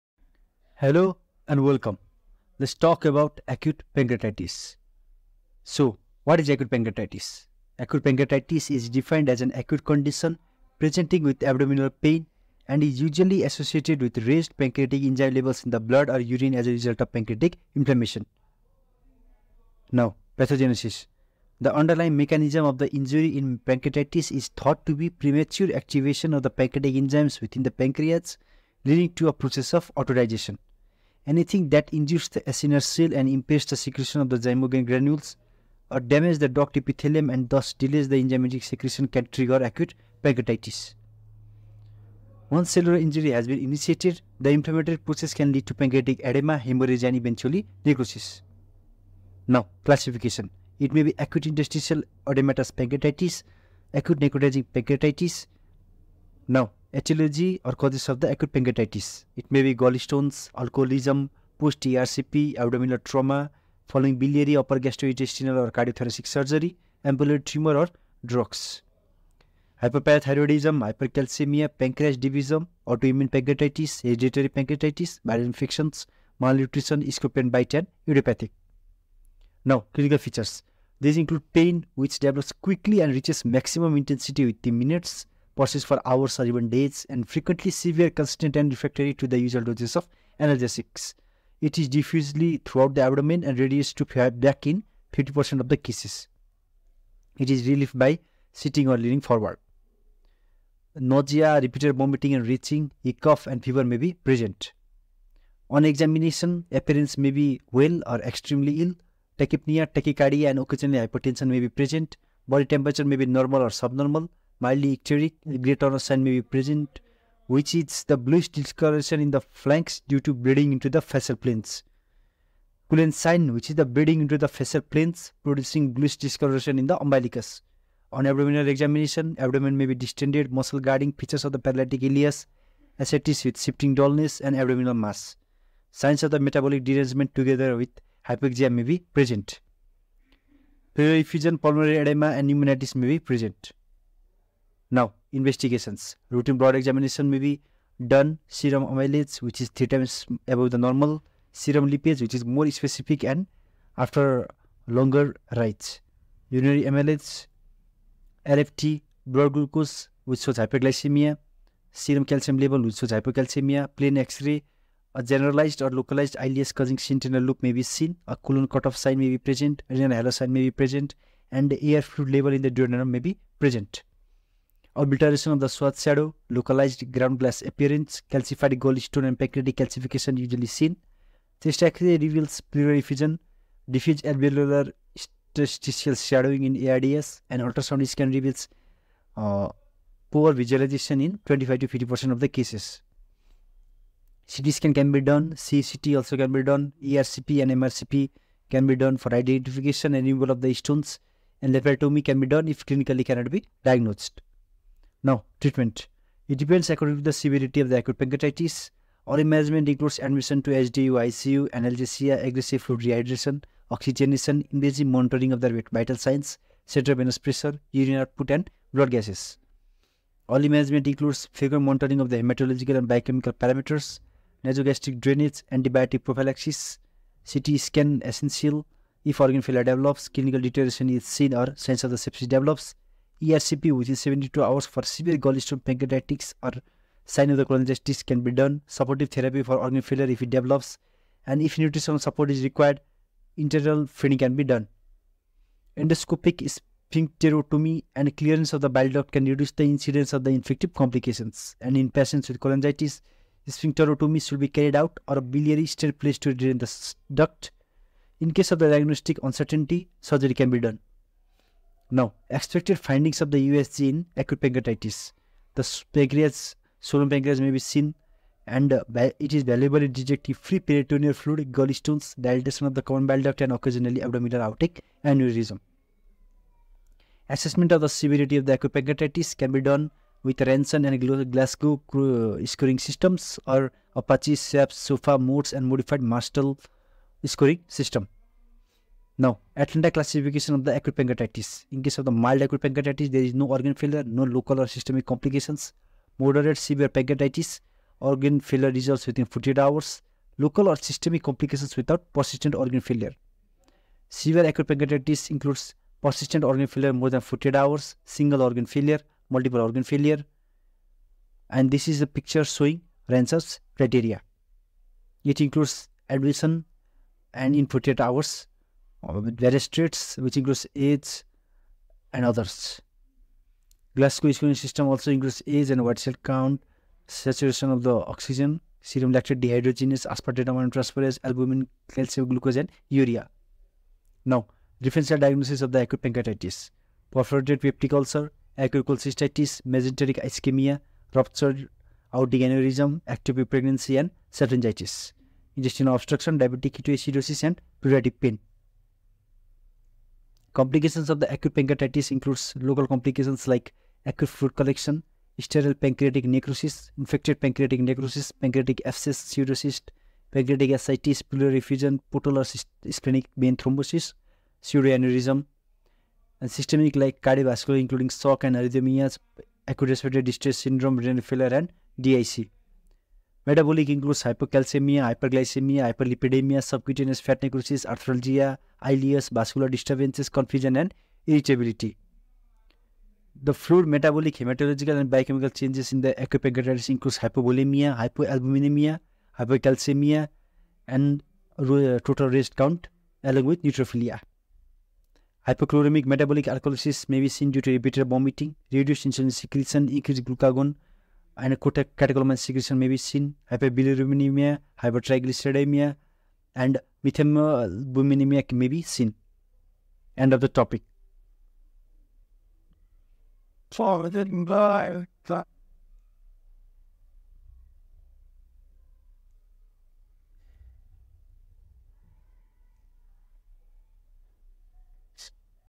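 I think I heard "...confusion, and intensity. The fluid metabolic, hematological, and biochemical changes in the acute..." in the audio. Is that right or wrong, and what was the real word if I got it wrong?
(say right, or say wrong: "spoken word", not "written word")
wrong: "irritability", not "intensity".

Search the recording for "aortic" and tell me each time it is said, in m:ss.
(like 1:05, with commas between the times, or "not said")
5:42.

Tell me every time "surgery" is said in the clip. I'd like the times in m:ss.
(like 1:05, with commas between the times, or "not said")
1:06, 4:20.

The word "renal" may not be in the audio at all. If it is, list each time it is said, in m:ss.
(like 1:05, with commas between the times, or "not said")
2:49, 6:11.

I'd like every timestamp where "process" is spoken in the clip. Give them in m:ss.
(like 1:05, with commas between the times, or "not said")
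0:29, 0:44.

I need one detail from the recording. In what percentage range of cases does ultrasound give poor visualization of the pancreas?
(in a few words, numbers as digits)
25 to 50%.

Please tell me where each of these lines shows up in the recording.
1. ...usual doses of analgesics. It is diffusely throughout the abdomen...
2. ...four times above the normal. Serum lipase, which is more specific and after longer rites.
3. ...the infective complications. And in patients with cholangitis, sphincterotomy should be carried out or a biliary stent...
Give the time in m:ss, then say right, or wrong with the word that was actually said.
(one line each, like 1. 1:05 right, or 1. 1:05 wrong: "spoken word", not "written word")
1. 1:29 right
2. 2:29 wrong: "three", not "four"
3. 4:10 right.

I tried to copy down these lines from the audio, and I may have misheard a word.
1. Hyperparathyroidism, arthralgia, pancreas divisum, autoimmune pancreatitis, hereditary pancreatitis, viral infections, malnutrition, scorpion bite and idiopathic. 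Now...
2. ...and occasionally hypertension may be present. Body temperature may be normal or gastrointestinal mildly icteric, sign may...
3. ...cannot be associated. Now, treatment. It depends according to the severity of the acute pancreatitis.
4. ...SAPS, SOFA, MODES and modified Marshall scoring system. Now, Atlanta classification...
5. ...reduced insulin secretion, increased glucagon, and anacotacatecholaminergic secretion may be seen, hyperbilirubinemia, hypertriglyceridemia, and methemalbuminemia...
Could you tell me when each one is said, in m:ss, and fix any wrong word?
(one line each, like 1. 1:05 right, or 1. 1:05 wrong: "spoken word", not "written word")
1. 1:09 wrong: "hypercalcemia", not "arthralgia"
2. 1:50 wrong: "subnormal", not "gastrointestinal"
3. 3:23 wrong: "diagnosed", not "associated"
4. 4:44 right
5. 6:38 right.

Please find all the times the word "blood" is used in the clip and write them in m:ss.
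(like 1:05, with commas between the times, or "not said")
0:15, 2:26, 2:39, 3:38.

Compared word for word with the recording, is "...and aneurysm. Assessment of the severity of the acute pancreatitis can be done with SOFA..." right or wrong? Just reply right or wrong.
wrong.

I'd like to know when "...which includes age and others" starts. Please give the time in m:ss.
5:20.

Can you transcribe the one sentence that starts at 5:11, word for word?
And this is a picture showing Ranson's criteria.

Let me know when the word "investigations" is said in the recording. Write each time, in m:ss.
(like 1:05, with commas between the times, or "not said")
2:25.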